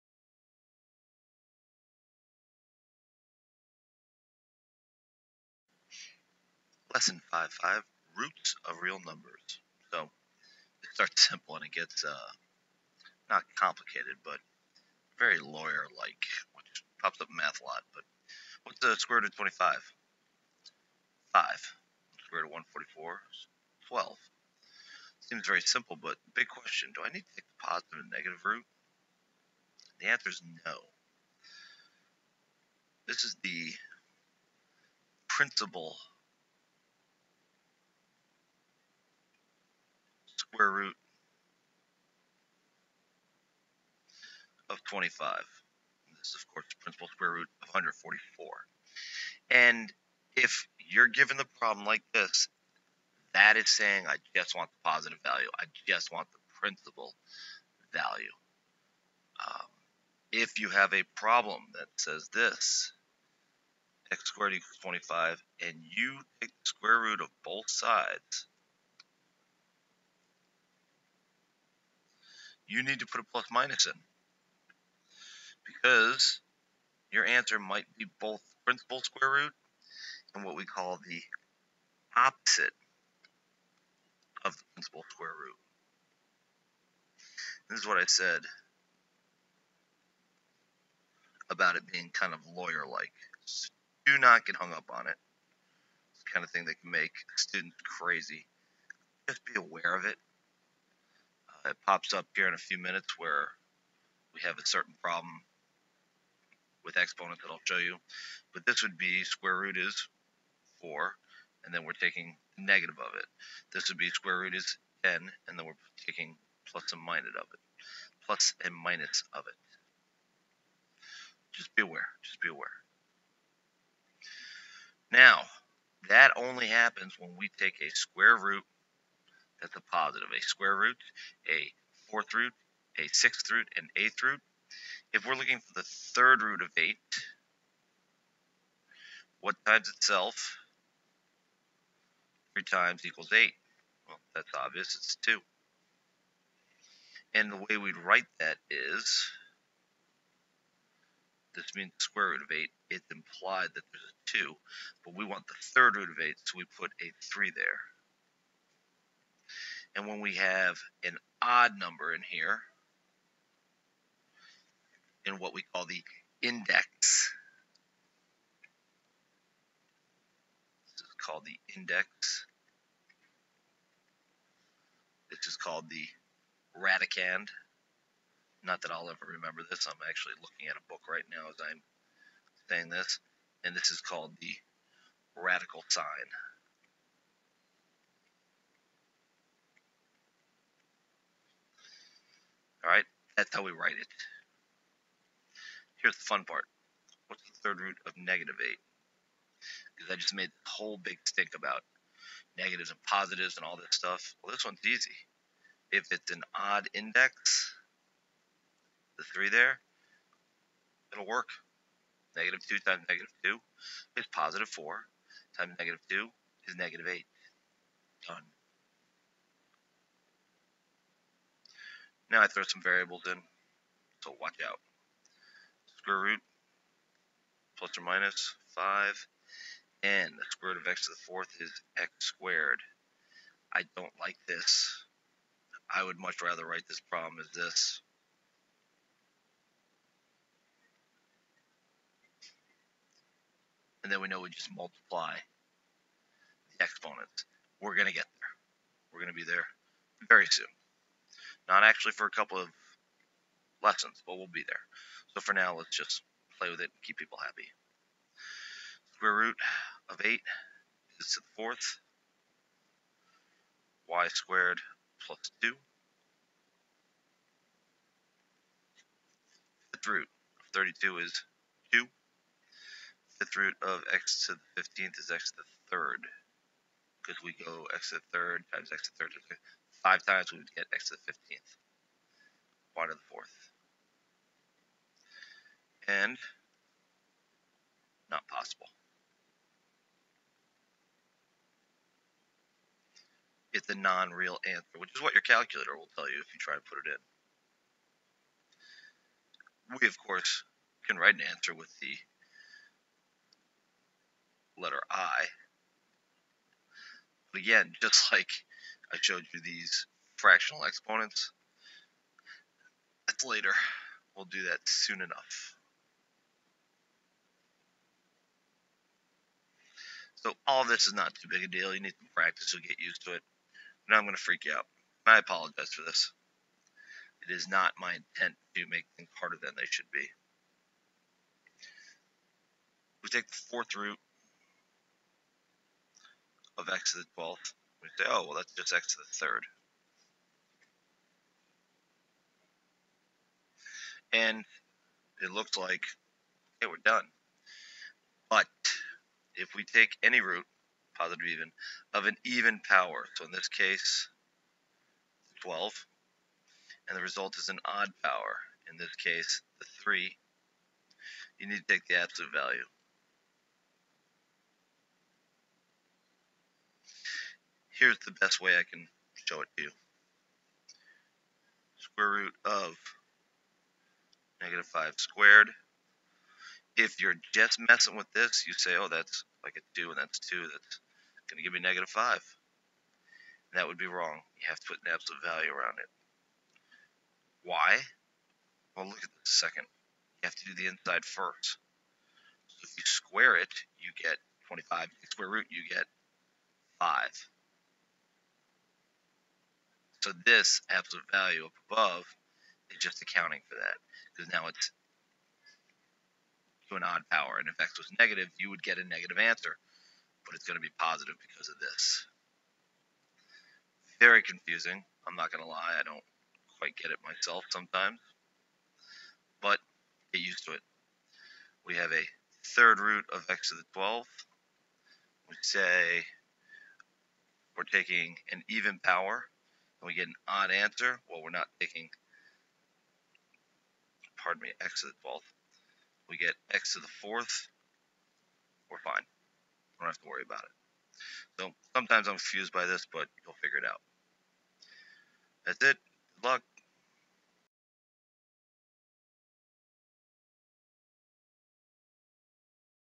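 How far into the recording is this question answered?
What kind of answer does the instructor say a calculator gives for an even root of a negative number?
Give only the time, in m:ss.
4:53.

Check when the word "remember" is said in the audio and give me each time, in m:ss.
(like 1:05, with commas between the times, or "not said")
2:59.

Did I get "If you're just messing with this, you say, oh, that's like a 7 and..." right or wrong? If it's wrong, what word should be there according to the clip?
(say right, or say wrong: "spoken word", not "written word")
wrong: "2", not "7".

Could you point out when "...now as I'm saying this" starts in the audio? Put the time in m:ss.
3:01.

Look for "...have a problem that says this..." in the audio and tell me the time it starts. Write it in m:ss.
1:00.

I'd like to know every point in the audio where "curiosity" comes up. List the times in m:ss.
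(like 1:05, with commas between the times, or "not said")
not said.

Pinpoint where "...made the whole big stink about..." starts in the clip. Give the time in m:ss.
3:20.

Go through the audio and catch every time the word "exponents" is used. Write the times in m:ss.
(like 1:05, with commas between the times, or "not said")
1:46, 4:06, 5:10.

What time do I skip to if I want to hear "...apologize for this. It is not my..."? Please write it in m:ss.
5:25.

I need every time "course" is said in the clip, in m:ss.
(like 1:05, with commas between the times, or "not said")
0:46, 5:00.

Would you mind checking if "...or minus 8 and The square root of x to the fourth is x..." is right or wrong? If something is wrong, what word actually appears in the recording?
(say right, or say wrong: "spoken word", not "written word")
wrong: "5", not "8".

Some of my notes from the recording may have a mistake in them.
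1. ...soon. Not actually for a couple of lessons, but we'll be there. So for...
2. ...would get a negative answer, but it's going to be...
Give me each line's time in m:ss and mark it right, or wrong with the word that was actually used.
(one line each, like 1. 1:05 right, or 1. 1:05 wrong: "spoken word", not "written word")
1. 4:10 right
2. 6:48 right.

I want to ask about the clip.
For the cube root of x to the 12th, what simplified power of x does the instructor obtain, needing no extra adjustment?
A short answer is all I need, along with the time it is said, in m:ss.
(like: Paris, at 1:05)
x to the 4th, at 7:16.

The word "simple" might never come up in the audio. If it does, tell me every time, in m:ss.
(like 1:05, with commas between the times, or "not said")
0:11, 0:25.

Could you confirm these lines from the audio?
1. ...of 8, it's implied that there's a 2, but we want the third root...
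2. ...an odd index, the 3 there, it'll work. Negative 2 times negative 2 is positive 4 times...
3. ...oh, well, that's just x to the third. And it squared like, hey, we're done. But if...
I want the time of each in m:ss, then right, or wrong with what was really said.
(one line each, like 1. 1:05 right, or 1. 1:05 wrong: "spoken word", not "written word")
1. 2:32 right
2. 3:26 right
3. 5:38 wrong: "looked", not "squared".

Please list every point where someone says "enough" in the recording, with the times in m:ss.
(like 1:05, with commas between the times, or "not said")
5:15.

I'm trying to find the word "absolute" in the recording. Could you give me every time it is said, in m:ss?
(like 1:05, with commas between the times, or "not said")
6:02, 6:25, 6:40.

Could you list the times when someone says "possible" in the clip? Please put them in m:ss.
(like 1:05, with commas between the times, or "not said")
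4:48.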